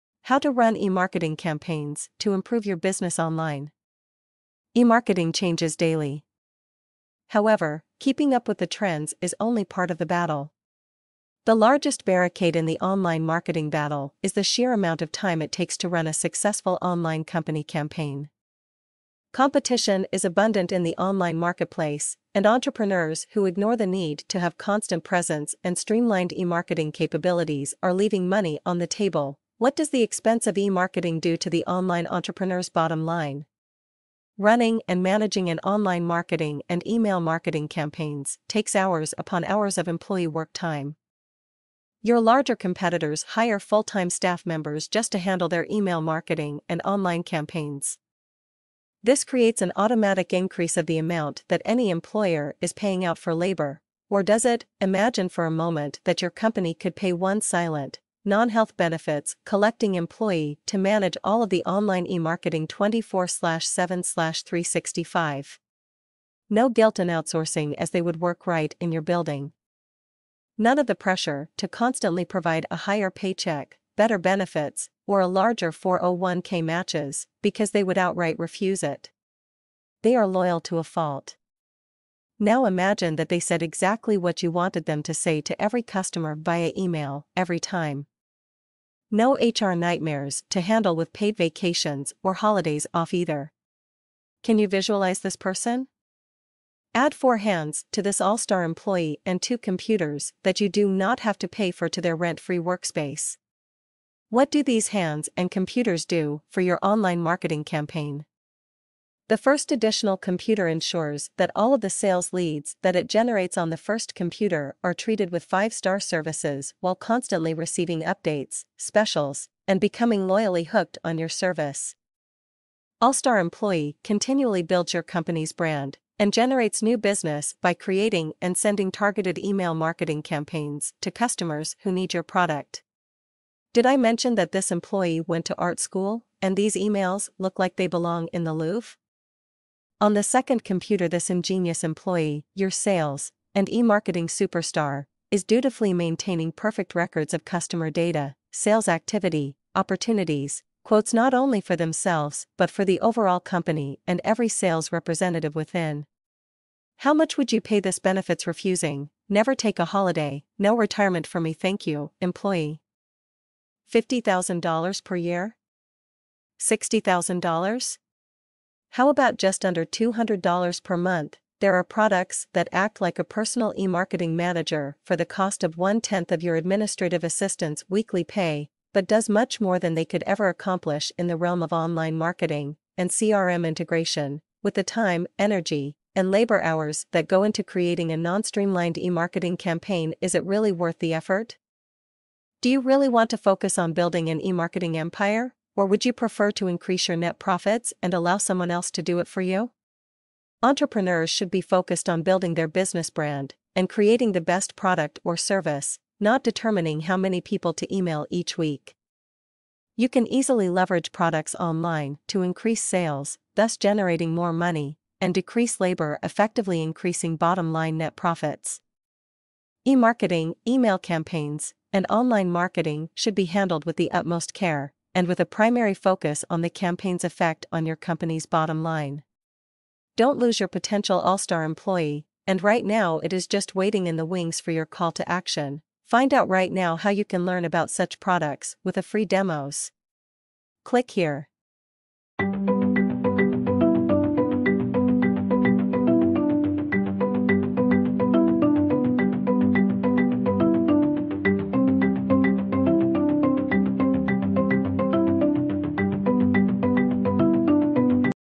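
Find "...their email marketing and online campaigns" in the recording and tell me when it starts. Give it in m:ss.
0:45.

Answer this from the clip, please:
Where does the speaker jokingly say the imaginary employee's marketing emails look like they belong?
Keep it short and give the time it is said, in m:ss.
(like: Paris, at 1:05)
the Louvre, at 2:18.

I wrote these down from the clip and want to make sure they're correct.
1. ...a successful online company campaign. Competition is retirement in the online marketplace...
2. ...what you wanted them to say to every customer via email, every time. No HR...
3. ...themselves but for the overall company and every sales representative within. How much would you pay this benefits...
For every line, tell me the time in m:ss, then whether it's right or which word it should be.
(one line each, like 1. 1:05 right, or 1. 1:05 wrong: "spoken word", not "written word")
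1. 0:16 wrong: "abundant", not "retirement"
2. 1:24 right
3. 2:31 right.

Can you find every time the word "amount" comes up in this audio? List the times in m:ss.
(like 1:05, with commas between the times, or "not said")
0:14, 0:50.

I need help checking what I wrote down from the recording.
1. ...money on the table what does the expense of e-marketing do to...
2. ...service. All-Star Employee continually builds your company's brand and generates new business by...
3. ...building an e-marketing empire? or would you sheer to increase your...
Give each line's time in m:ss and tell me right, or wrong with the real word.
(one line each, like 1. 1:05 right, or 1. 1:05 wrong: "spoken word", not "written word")
1. 0:28 right
2. 2:01 right
3. 3:13 wrong: "prefer", not "sheer".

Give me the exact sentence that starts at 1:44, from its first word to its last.
What do these hands and computers do for your online marketing campaign?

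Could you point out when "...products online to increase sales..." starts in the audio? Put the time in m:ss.
3:31.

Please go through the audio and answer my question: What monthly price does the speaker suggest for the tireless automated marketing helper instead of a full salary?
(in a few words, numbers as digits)
just under $200.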